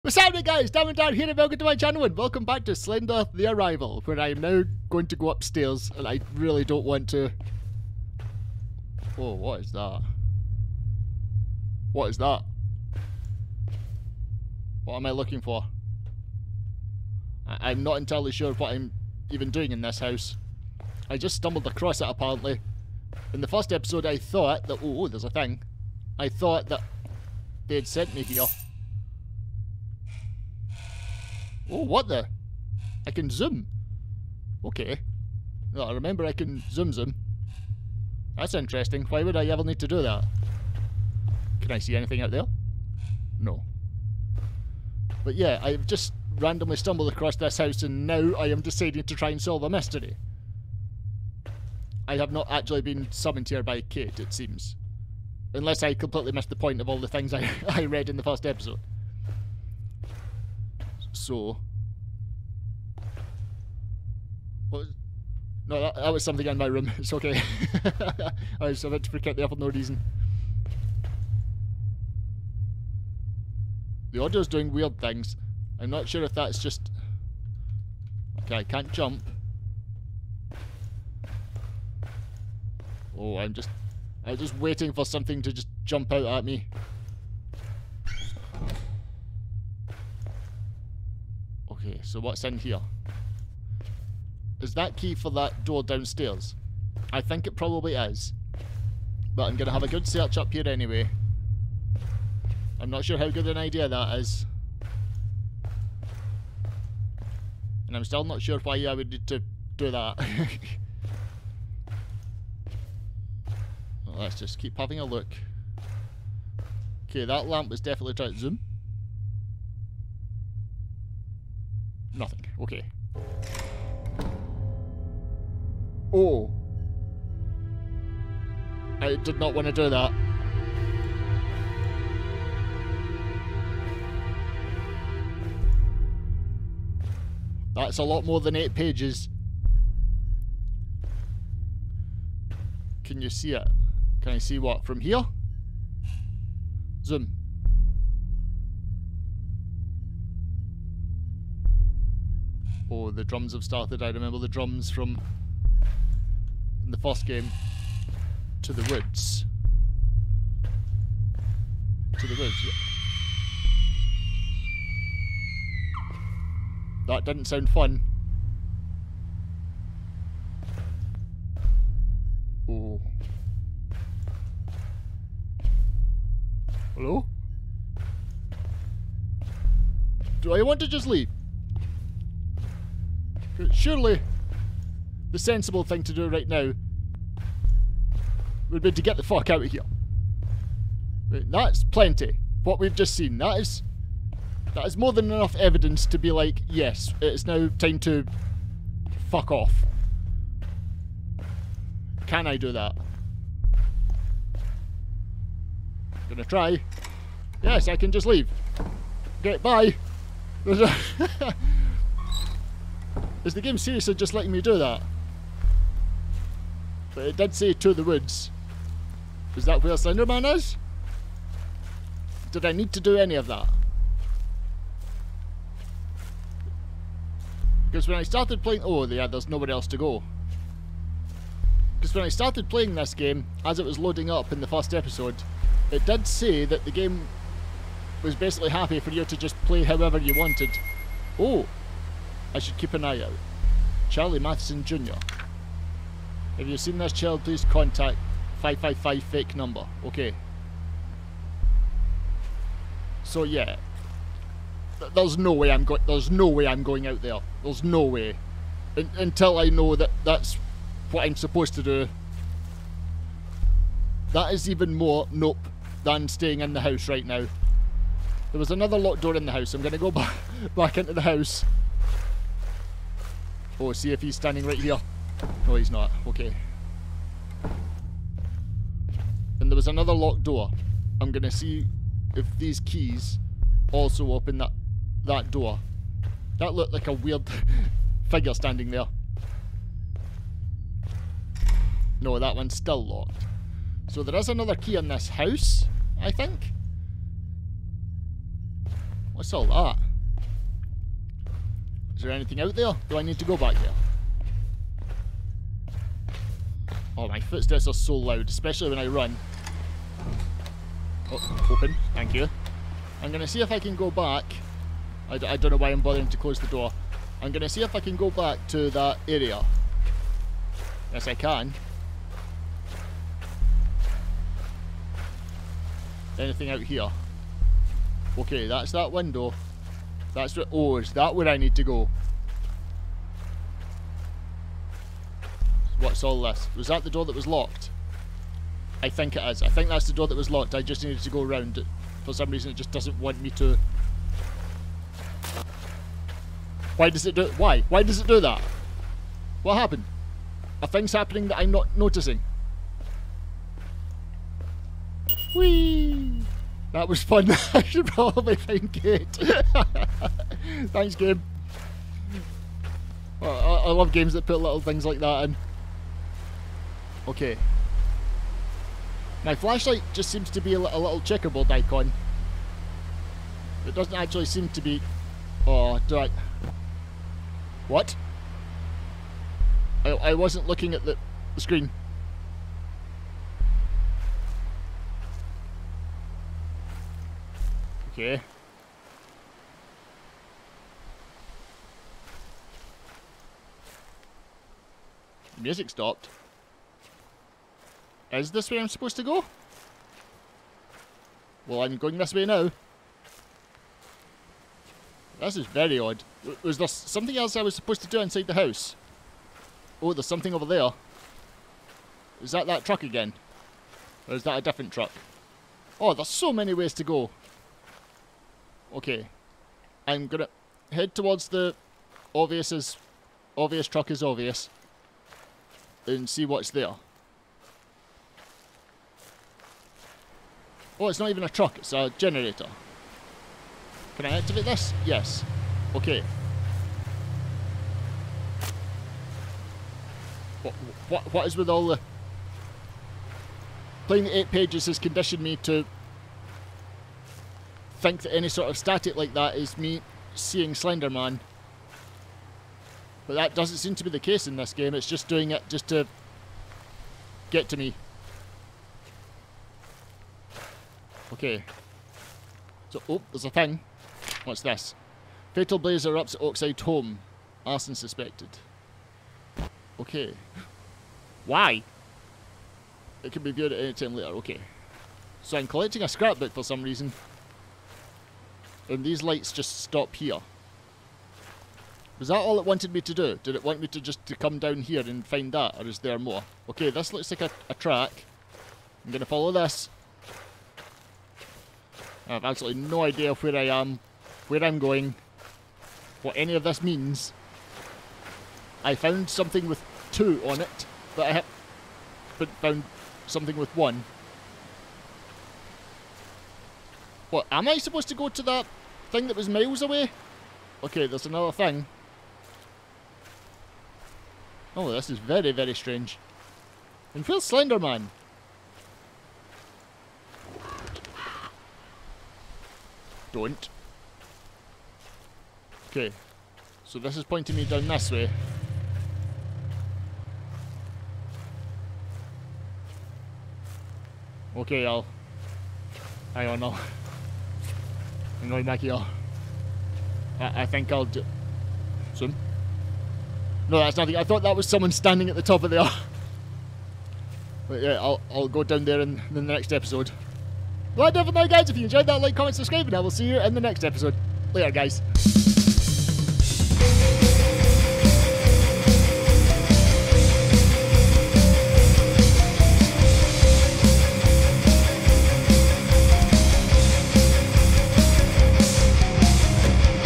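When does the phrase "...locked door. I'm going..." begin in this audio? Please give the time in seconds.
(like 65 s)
280 s.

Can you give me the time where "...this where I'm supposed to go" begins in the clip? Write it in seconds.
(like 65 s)
398 s.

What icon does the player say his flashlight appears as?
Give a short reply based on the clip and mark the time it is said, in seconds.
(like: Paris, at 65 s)
Checkerboard, at 371 s.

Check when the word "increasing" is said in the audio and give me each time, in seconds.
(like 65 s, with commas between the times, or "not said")
not said.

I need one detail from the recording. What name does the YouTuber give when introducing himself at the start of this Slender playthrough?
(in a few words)
Diamondire.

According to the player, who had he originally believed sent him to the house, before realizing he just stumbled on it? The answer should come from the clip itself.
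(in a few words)
Kate.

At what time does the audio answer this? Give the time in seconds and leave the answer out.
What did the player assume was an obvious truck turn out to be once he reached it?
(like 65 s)
432 s.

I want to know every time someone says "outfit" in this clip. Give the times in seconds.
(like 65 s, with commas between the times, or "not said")
not said.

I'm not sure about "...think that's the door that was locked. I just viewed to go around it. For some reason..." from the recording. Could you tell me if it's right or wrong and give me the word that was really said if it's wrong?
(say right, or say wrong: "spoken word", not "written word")
wrong: "needed", not "viewed".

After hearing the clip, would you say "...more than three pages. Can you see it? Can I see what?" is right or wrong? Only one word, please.
wrong.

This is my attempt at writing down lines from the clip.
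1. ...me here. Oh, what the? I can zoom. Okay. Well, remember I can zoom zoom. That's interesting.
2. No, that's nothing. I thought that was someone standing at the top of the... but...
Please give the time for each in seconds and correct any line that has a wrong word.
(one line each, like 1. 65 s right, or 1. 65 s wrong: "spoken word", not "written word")
1. 28 s right
2. 543 s right.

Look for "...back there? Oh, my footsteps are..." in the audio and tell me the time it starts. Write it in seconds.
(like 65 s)
303 s.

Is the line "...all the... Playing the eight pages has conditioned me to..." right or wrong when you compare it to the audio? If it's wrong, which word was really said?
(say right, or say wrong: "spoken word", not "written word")
right.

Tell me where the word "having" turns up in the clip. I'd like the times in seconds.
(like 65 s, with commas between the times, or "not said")
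114 s.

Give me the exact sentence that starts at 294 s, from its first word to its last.
So there is another key in this house, I think.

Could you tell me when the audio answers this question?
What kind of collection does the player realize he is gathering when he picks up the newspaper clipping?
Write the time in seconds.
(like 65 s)
476 s.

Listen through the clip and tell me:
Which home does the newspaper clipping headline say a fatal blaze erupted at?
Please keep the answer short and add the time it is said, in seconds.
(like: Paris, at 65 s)
Oakside Home, at 466 s.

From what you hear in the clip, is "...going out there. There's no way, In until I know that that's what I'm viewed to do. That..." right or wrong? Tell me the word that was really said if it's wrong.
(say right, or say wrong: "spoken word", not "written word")
wrong: "supposed", not "viewed".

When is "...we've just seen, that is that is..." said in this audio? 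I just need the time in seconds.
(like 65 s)
192 s.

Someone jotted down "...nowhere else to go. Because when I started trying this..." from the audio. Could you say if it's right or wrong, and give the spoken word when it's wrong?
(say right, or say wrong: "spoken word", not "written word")
wrong: "playing", not "trying".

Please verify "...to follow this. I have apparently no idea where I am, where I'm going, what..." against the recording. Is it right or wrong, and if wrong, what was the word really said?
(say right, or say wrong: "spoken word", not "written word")
wrong: "absolutely", not "apparently".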